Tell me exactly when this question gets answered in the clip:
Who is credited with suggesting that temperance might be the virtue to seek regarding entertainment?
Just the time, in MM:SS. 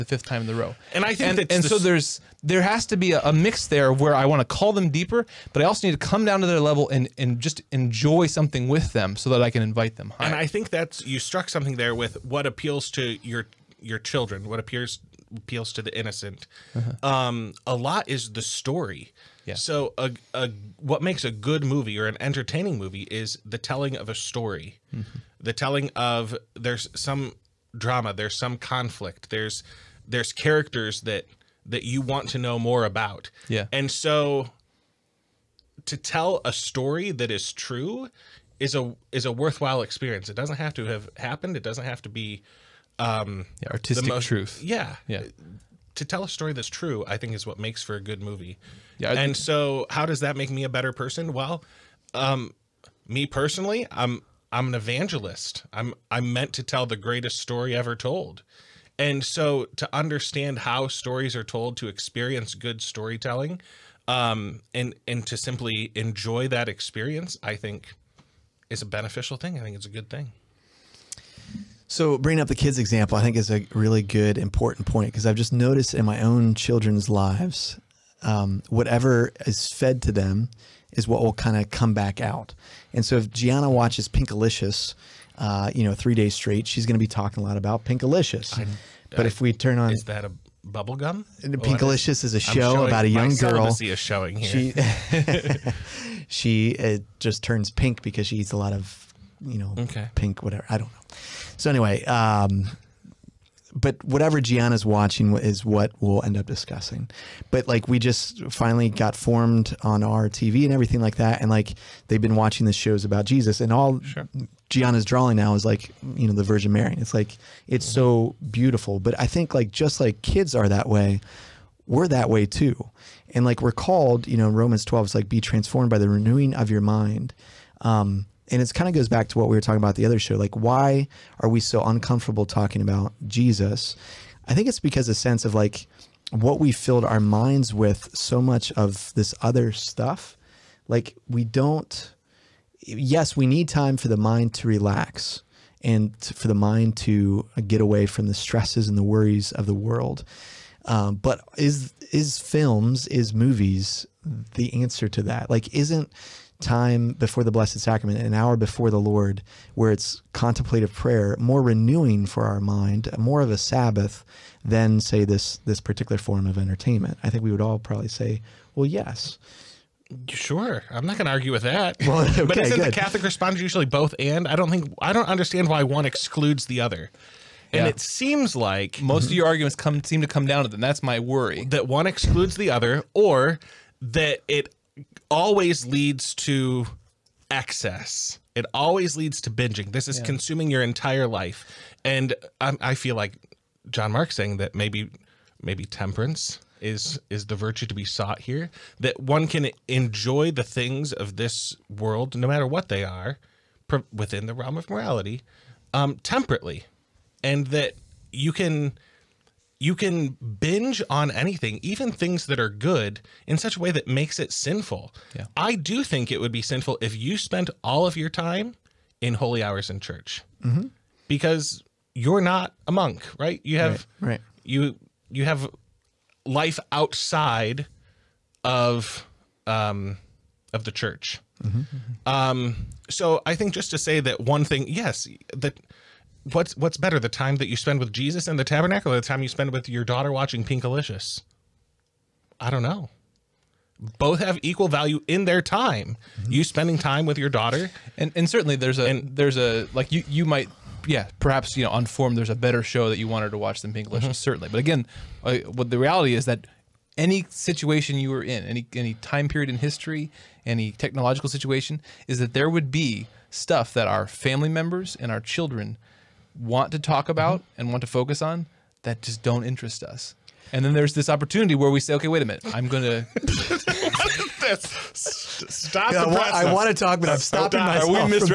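03:13.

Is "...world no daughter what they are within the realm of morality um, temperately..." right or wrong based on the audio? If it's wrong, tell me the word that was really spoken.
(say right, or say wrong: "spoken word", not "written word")
wrong: "matter", not "daughter".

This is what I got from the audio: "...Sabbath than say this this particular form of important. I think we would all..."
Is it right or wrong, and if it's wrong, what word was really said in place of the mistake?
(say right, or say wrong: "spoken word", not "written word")
wrong: "entertainment", not "important".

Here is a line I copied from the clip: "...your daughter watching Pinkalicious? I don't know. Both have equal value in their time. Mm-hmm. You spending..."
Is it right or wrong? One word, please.
right.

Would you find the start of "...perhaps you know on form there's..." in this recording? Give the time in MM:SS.
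04:11.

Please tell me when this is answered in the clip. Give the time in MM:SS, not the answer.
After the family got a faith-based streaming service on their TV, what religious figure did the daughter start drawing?
01:56.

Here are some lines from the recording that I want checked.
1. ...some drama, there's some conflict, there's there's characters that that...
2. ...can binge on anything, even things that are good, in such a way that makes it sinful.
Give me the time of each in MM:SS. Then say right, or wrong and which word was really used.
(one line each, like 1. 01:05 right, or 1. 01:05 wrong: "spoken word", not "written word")
1. 00:26 right
2. 03:29 right.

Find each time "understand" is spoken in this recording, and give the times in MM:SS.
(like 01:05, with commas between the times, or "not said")
00:59, 02:55.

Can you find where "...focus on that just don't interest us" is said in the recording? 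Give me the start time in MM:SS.
04:28.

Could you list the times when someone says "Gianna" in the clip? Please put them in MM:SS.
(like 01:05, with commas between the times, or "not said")
01:23, 01:44, 01:54.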